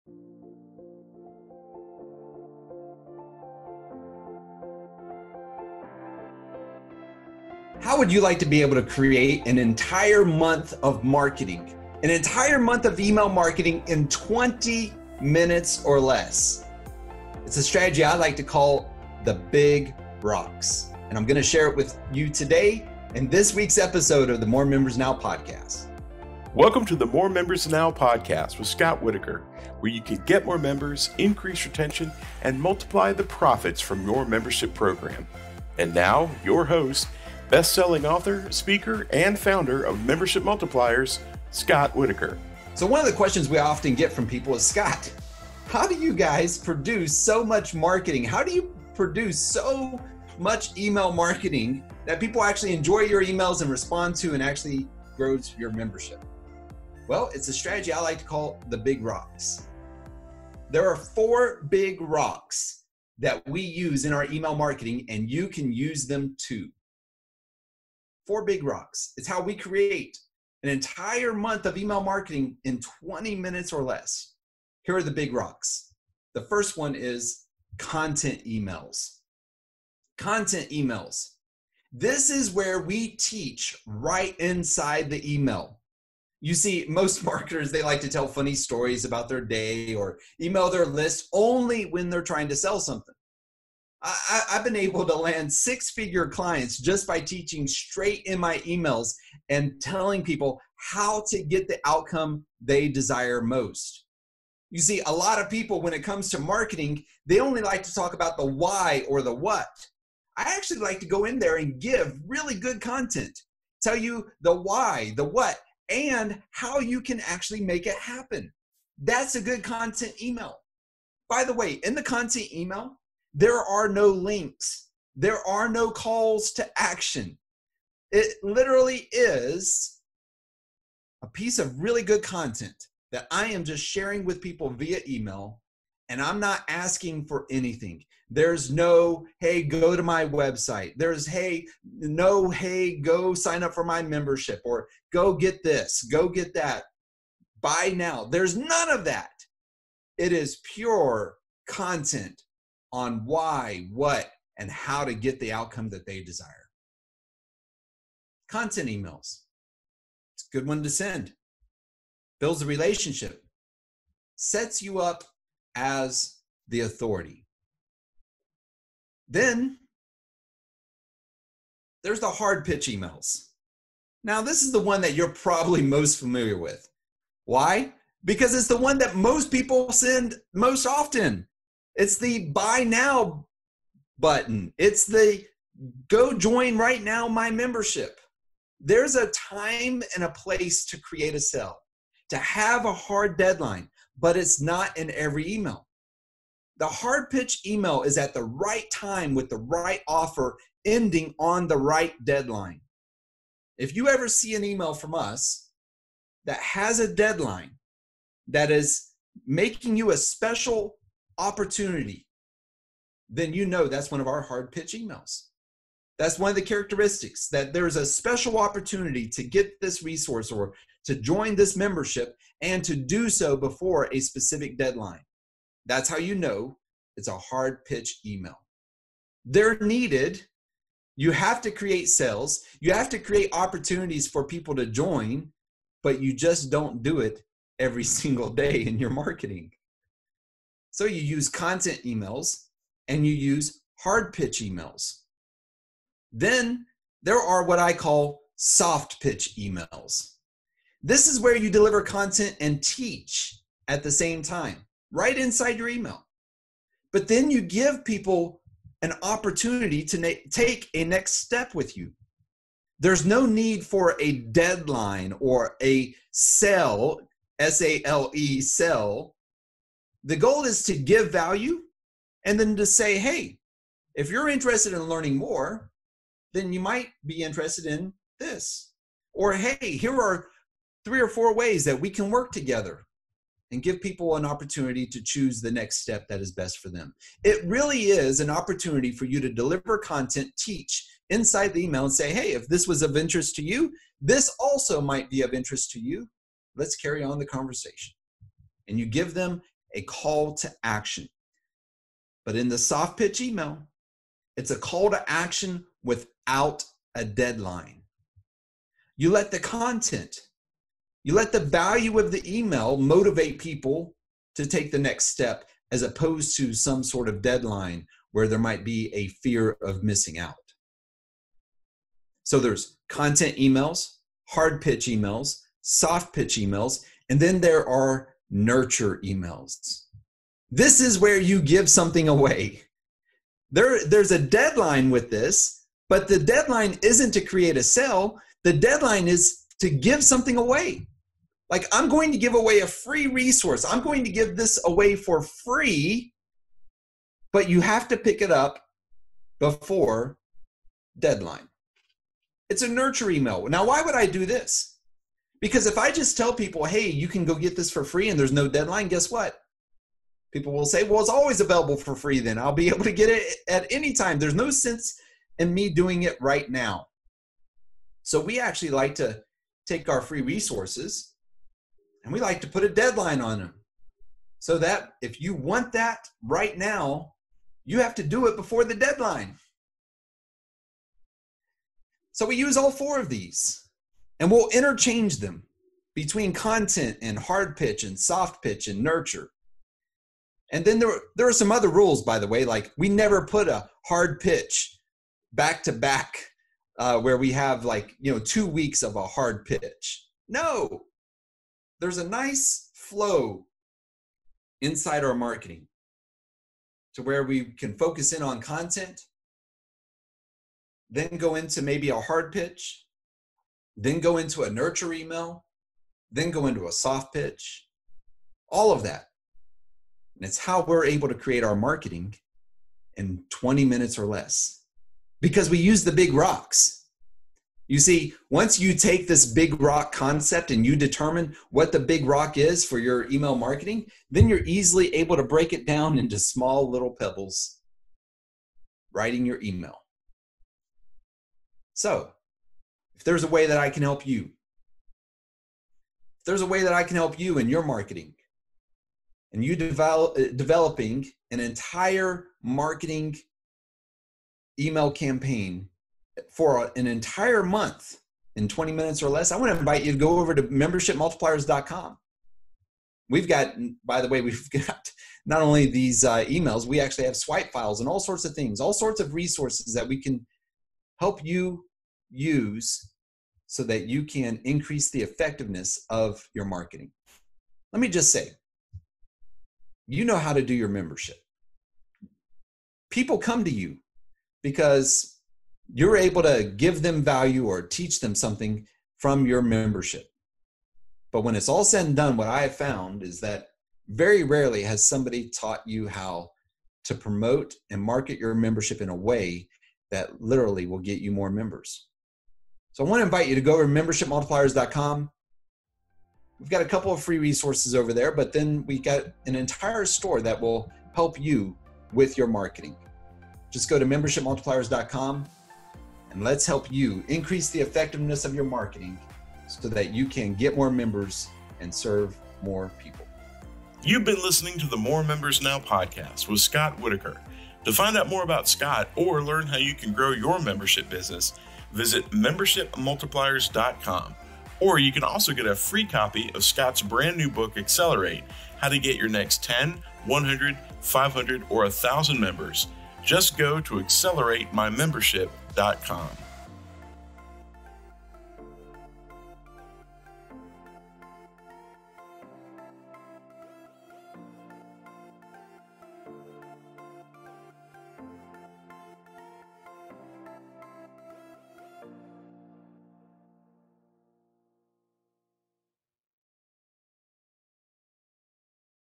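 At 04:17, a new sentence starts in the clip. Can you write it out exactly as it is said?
But then you give people an opportunity to na- take a next step with you.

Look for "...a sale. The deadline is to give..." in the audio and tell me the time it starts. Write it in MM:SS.
05:37.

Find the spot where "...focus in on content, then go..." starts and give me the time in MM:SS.
06:47.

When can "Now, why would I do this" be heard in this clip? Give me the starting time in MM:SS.
05:53.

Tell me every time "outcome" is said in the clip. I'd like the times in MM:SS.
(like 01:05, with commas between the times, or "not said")
01:41, 02:35.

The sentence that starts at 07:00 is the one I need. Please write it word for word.
And it's how we're able to create our marketing in 20 minutes or less because we use the big rocks.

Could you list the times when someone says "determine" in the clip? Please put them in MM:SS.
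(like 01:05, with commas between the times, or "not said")
07:10.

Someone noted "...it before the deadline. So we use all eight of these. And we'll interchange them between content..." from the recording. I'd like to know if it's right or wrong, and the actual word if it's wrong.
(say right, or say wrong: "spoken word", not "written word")
wrong: "four", not "eight".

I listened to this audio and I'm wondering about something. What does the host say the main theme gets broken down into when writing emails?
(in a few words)
Small little pebbles.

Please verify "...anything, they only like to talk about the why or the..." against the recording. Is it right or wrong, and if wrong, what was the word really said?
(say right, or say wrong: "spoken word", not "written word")
wrong: "marketing", not "anything".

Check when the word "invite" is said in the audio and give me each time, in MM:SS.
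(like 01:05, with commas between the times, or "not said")
07:39, 08:23.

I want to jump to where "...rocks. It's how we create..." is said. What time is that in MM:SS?
01:08.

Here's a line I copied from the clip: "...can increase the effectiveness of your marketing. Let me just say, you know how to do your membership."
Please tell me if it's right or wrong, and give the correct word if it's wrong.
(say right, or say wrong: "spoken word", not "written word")
right.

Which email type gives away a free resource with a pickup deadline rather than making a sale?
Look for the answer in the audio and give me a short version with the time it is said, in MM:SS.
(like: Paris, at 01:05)
Nurture emails, at 05:28.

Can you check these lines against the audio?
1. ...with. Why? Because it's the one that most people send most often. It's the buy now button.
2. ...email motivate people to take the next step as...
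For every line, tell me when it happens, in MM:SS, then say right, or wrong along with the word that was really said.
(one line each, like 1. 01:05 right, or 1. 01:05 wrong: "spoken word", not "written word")
1. 02:56 right
2. 05:12 right.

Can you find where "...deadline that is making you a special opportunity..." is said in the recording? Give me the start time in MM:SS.
03:27.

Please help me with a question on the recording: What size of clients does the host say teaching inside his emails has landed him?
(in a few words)
Six figure.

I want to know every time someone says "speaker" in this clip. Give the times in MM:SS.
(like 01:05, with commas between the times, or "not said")
00:38.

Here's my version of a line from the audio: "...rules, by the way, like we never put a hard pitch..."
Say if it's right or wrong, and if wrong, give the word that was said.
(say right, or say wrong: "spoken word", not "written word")
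right.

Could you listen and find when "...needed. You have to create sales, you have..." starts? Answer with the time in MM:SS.
03:49.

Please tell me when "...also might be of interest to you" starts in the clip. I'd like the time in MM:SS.
04:54.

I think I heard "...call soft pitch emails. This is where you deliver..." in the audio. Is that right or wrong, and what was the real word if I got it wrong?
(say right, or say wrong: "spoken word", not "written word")
right.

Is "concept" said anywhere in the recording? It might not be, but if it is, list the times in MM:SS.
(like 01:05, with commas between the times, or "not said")
07:10.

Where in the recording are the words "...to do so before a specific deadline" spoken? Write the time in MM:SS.
03:42.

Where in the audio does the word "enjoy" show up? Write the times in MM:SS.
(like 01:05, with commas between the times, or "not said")
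00:52.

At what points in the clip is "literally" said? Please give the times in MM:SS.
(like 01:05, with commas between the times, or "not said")
02:08, 08:20.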